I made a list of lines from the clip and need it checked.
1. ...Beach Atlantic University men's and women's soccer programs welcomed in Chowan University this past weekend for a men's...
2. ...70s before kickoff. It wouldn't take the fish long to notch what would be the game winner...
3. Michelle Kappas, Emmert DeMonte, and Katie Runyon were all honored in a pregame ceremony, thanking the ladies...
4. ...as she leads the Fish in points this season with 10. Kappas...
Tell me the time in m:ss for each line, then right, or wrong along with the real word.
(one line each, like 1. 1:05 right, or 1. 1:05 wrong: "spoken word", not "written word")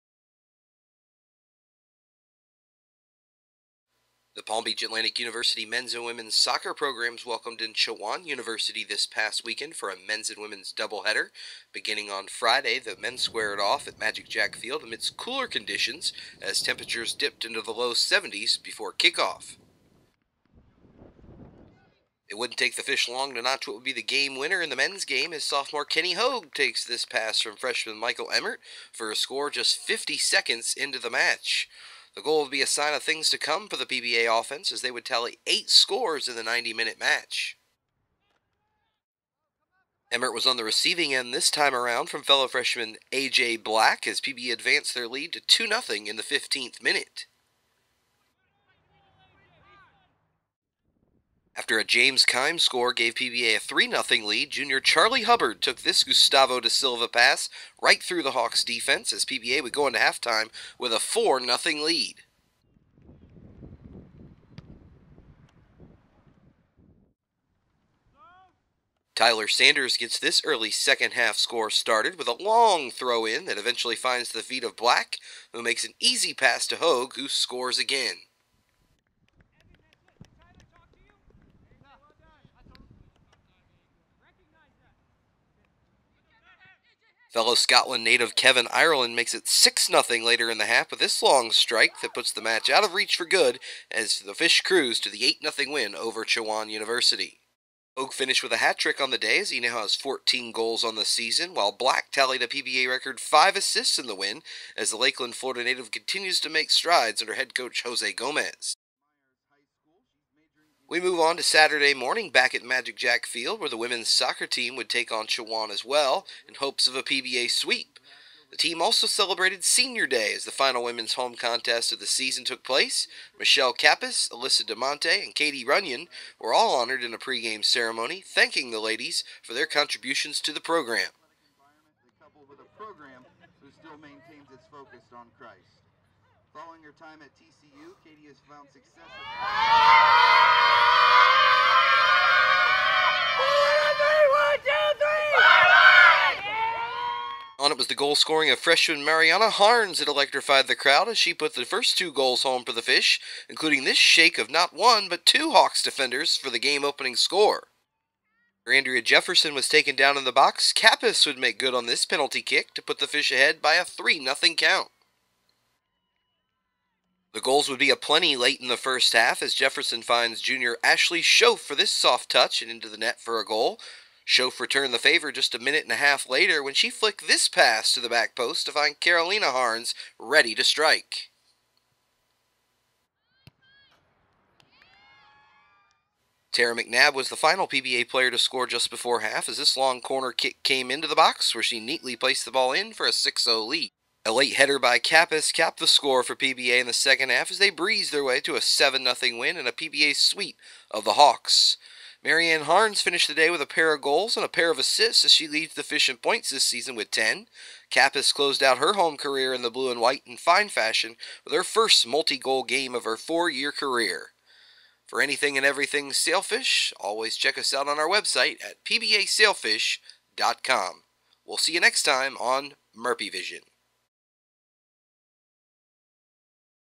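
1. 0:04 right
2. 0:17 right
3. 2:03 wrong: "Alyssa", not "Emmert"
4. 3:25 right.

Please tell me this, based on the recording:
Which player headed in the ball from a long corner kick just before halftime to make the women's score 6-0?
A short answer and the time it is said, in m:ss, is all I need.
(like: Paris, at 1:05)
Tara McNabb, at 3:06.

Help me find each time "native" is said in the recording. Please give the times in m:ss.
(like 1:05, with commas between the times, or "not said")
1:28, 1:45.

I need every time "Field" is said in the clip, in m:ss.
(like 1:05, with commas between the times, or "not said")
0:14, 1:53.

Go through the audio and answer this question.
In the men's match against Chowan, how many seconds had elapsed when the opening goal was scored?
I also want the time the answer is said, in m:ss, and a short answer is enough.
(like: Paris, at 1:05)
50, at 0:29.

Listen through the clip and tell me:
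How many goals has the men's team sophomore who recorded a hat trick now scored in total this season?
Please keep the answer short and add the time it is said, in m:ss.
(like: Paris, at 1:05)
14, at 1:39.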